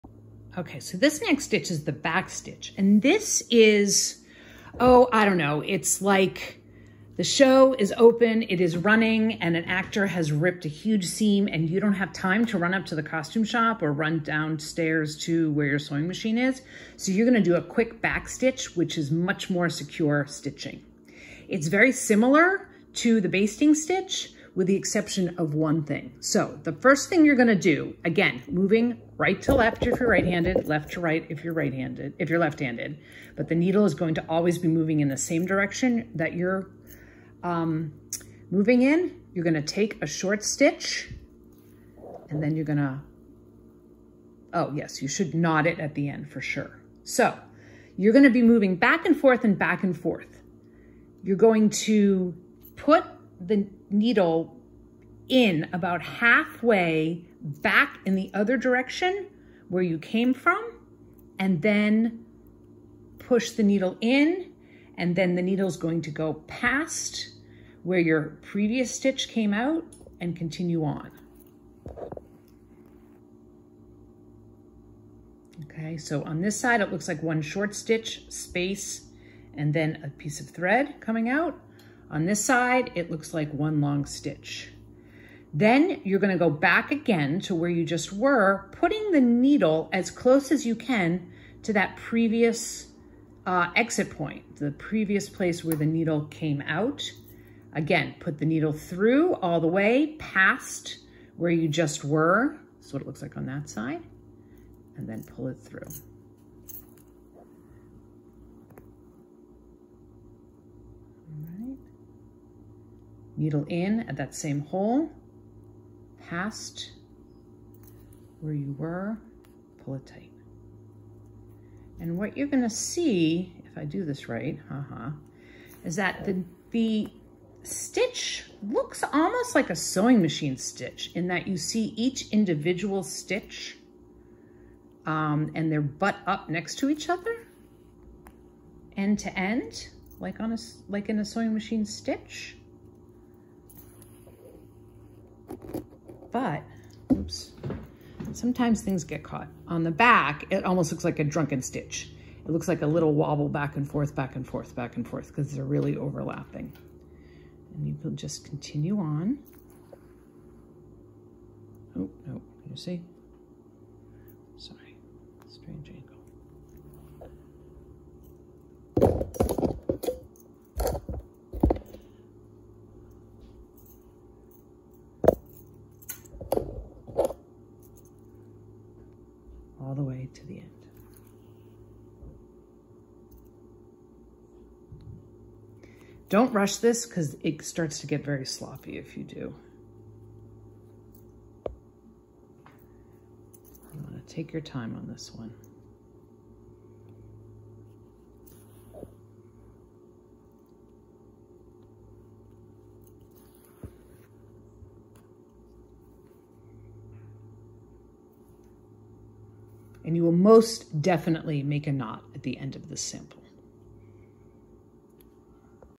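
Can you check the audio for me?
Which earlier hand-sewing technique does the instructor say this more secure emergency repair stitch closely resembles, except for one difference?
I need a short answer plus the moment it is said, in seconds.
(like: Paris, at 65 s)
basting stitch, at 23 s.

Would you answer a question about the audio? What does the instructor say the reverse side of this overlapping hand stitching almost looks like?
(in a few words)
drunken stitch.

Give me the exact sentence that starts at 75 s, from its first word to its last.
Okay, so on this side, it looks like one short stitch, space, and then a piece of thread coming out.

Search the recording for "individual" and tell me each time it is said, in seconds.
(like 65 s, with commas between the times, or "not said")
132 s.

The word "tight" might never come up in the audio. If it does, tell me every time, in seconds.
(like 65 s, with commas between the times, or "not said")
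120 s.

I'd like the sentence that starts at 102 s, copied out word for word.
That's what it looks like on that side.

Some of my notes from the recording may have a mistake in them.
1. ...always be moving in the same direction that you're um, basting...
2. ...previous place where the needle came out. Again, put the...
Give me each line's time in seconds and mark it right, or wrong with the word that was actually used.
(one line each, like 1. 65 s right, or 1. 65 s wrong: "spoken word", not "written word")
1. 34 s wrong: "moving", not "basting"
2. 94 s right.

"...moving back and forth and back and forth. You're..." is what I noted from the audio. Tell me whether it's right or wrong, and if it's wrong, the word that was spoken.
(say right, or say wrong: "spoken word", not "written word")
right.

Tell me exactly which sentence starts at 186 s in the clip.
Don't rush this because it starts to get very sloppy if you do.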